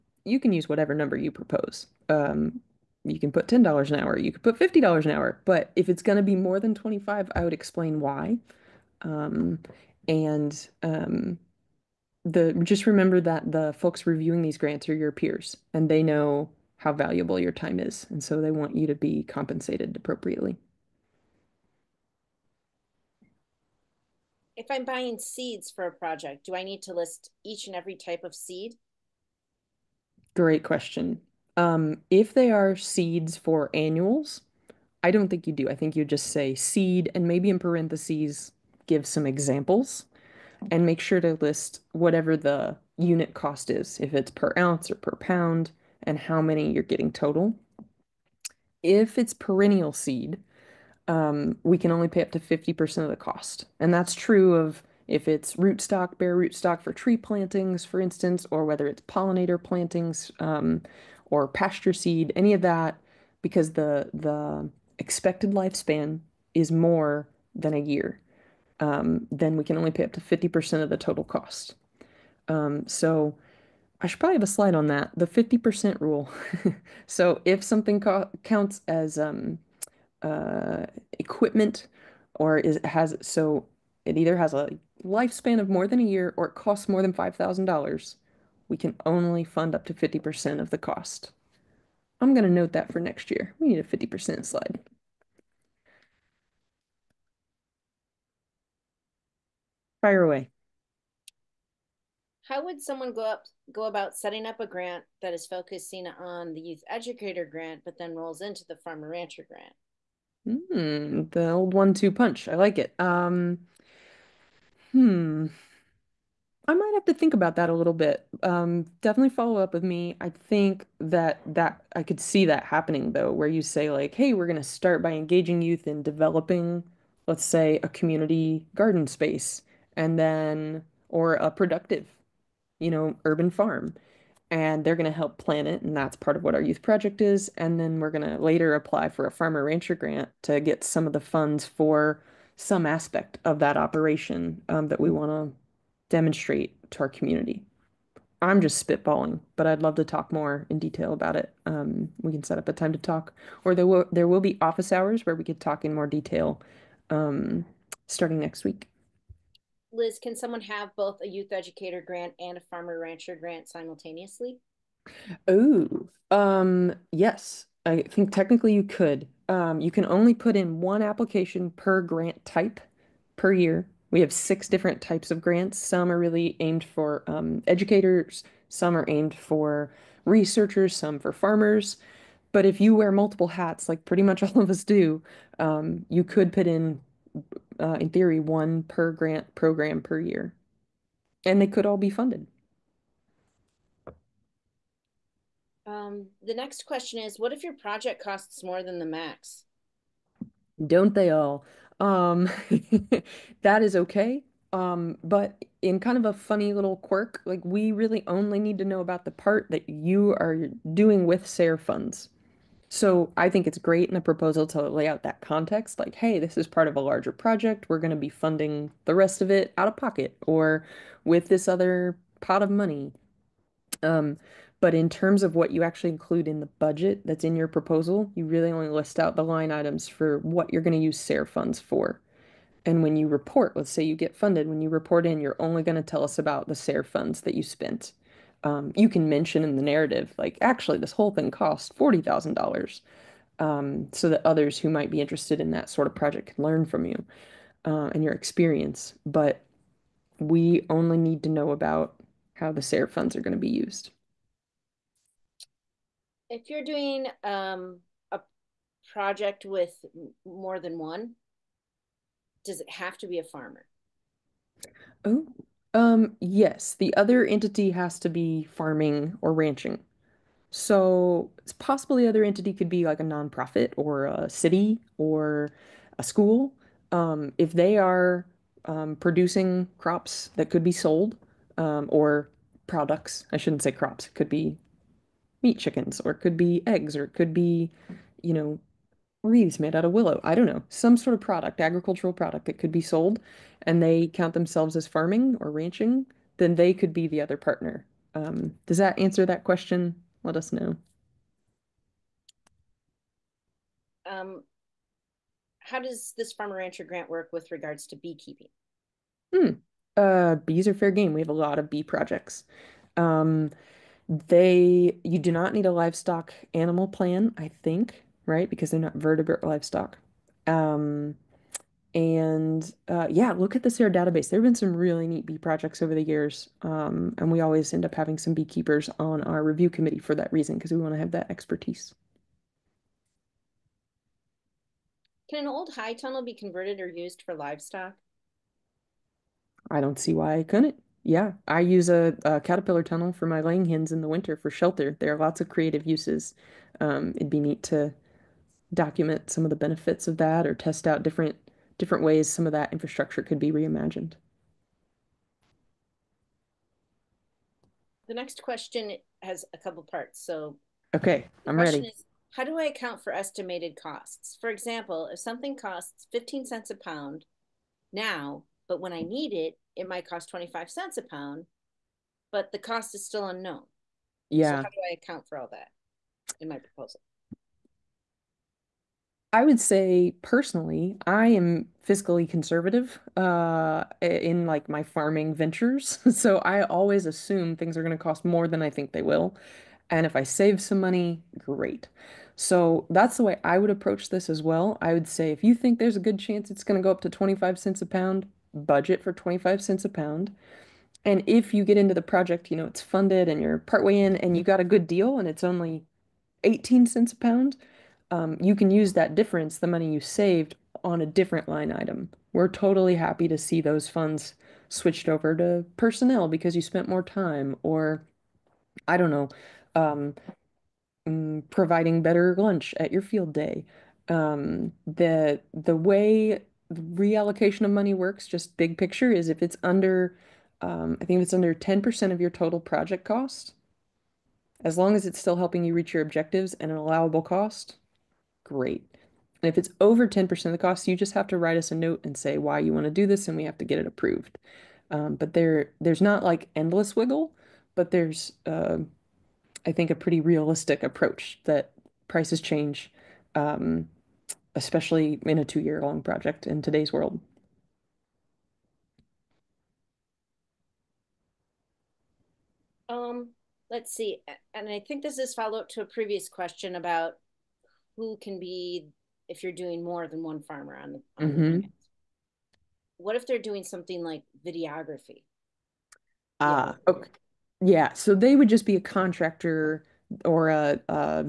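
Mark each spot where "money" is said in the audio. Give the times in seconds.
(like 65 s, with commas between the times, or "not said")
222 s, 391 s, 409 s, 427 s.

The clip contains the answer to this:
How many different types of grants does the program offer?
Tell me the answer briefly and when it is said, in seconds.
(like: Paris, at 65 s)
6, at 174 s.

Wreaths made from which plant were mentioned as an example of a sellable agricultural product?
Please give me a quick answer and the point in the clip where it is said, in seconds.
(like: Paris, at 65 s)
willow, at 290 s.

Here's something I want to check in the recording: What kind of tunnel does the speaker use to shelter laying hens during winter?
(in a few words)
caterpillar tunnel.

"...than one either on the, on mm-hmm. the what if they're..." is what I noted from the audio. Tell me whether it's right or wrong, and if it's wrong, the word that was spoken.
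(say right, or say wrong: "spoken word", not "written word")
wrong: "farmer", not "either".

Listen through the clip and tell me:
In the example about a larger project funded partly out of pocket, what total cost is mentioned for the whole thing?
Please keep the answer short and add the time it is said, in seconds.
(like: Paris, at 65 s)
$40,000, at 241 s.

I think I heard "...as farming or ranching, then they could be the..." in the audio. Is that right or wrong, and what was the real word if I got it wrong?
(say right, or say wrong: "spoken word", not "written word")
right.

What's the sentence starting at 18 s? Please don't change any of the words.
And so they want you to be compensated appropriately.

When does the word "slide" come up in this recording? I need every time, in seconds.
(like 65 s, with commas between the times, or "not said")
74 s, 94 s.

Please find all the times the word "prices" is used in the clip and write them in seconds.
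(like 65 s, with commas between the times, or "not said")
452 s.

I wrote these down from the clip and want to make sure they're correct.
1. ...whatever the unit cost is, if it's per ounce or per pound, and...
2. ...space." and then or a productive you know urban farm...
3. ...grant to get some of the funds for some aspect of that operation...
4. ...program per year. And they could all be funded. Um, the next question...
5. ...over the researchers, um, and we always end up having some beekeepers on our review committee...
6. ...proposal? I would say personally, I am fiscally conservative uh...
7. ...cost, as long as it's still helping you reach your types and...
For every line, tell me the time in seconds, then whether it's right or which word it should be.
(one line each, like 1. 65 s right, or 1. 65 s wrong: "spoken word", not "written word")
1. 41 s right
2. 129 s right
3. 139 s right
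4. 189 s right
5. 326 s wrong: "years", not "researchers"
6. 376 s right
7. 433 s wrong: "objectives", not "types".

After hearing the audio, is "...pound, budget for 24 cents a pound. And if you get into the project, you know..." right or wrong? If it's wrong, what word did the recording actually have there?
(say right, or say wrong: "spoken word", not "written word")
wrong: "25", not "24".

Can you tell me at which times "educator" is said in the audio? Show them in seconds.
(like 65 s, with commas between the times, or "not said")
106 s, 161 s, 177 s.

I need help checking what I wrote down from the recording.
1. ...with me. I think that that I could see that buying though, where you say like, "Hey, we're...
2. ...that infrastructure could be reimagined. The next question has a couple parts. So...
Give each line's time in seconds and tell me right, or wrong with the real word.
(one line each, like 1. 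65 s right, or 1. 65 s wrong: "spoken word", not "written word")
1. 119 s wrong: "happening", not "buying"
2. 352 s right.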